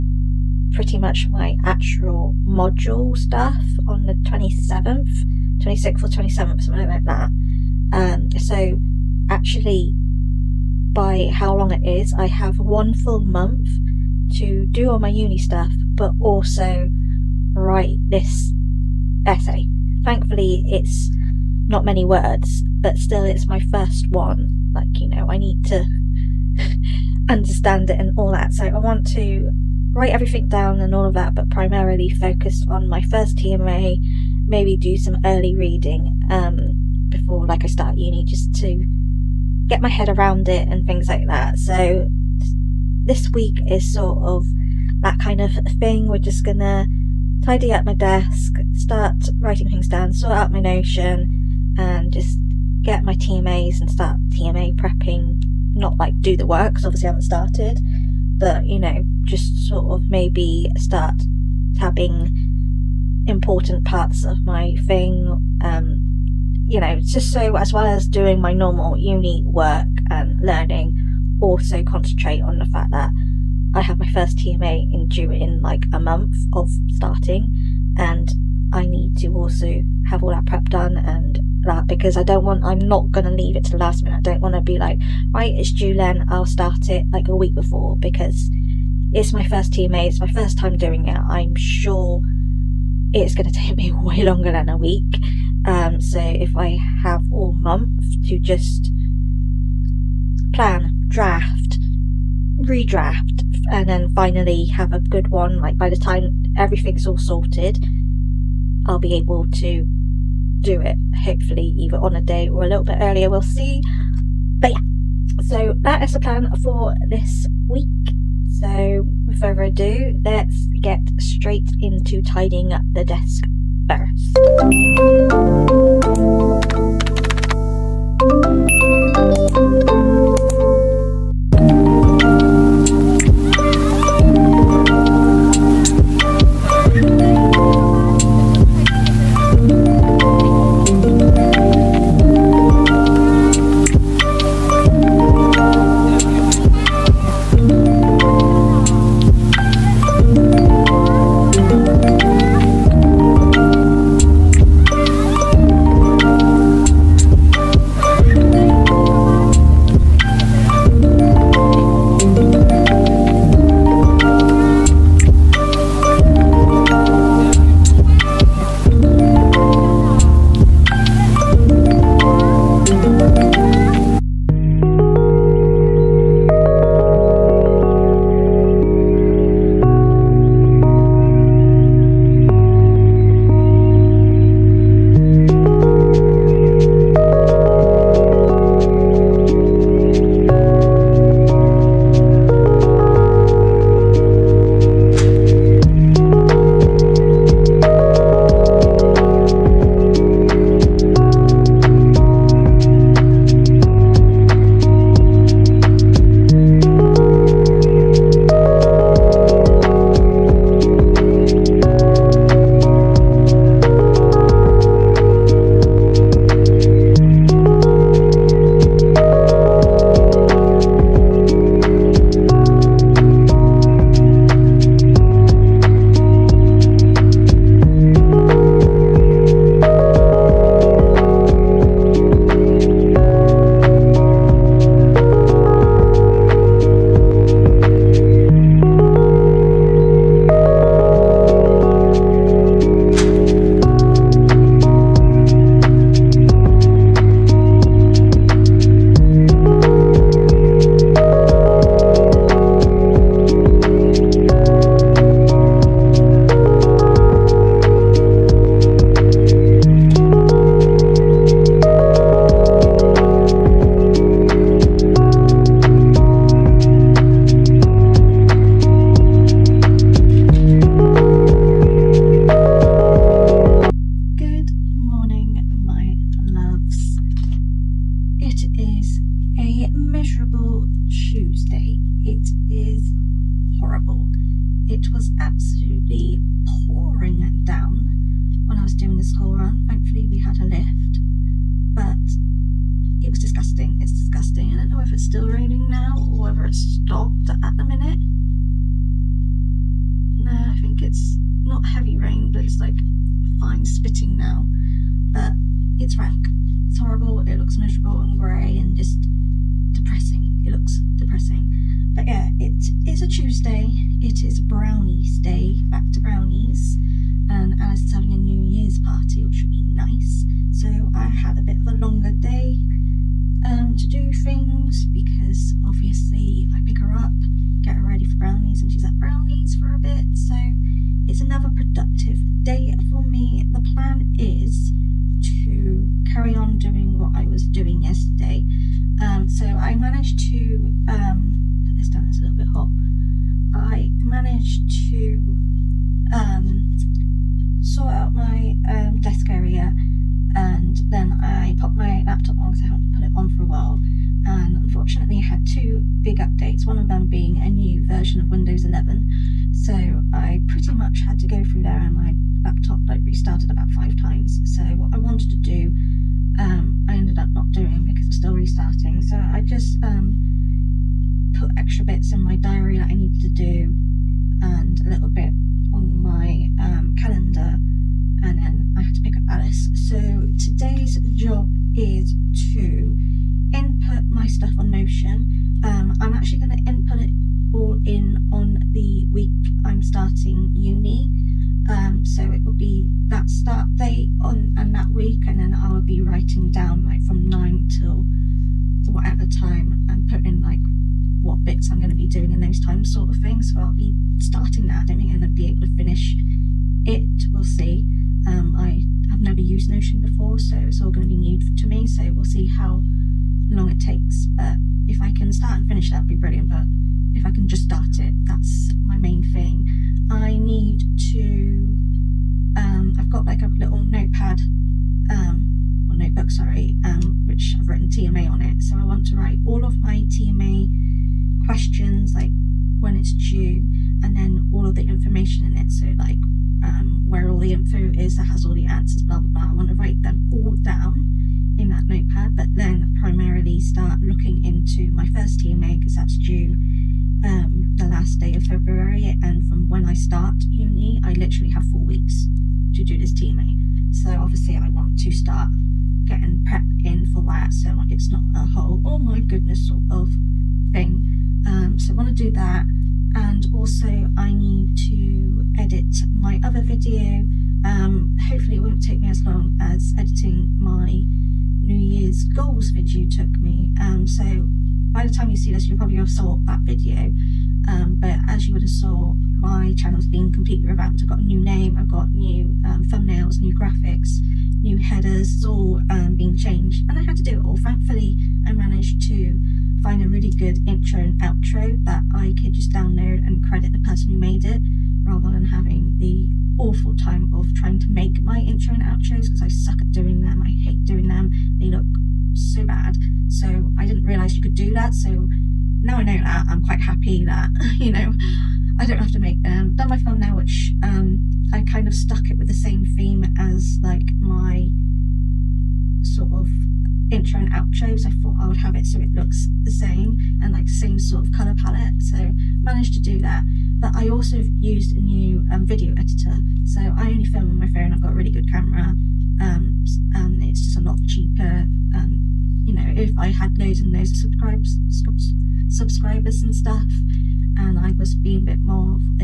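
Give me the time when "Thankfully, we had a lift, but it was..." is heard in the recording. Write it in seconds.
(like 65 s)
289 s.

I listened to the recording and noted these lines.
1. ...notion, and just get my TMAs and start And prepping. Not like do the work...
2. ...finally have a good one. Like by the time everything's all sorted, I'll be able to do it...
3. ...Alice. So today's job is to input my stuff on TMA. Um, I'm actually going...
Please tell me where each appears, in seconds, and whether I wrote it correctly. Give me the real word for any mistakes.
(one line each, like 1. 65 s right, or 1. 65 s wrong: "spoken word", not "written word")
1. 50 s wrong: "TMA", not "And"
2. 104 s right
3. 379 s wrong: "Notion", not "TMA".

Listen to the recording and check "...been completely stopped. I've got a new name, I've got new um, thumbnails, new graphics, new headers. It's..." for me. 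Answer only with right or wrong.
wrong.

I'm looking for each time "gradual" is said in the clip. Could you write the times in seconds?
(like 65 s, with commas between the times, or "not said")
not said.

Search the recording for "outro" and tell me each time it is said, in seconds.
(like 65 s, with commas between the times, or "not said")
491 s, 499 s, 517 s.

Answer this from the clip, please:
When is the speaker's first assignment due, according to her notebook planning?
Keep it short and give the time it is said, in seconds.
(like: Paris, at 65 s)
last day of February, at 447 s.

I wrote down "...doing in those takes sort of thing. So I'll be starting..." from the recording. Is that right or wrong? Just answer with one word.
wrong.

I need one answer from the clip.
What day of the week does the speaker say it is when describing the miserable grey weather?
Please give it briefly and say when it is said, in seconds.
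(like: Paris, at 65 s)
Tuesday, at 313 s.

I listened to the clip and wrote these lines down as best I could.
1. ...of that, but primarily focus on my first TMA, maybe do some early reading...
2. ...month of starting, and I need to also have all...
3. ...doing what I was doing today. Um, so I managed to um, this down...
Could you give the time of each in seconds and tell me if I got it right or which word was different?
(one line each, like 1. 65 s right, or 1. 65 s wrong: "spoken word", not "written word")
1. 31 s right
2. 75 s right
3. 336 s wrong: "yesterday", not "today".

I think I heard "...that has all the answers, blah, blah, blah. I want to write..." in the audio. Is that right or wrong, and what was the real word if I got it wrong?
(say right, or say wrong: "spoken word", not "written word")
right.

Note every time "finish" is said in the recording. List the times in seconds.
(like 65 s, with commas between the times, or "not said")
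405 s, 415 s.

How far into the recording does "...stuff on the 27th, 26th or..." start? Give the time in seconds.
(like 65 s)
3 s.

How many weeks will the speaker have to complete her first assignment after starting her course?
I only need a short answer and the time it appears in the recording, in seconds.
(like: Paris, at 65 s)
4, at 451 s.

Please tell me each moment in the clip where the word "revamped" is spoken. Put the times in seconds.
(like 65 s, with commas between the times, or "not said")
480 s.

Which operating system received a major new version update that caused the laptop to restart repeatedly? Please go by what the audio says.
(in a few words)
Windows 11.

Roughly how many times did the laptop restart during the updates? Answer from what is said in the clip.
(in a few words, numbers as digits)
5.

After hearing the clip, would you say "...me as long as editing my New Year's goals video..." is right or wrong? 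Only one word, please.
right.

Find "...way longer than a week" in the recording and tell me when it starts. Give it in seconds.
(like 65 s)
93 s.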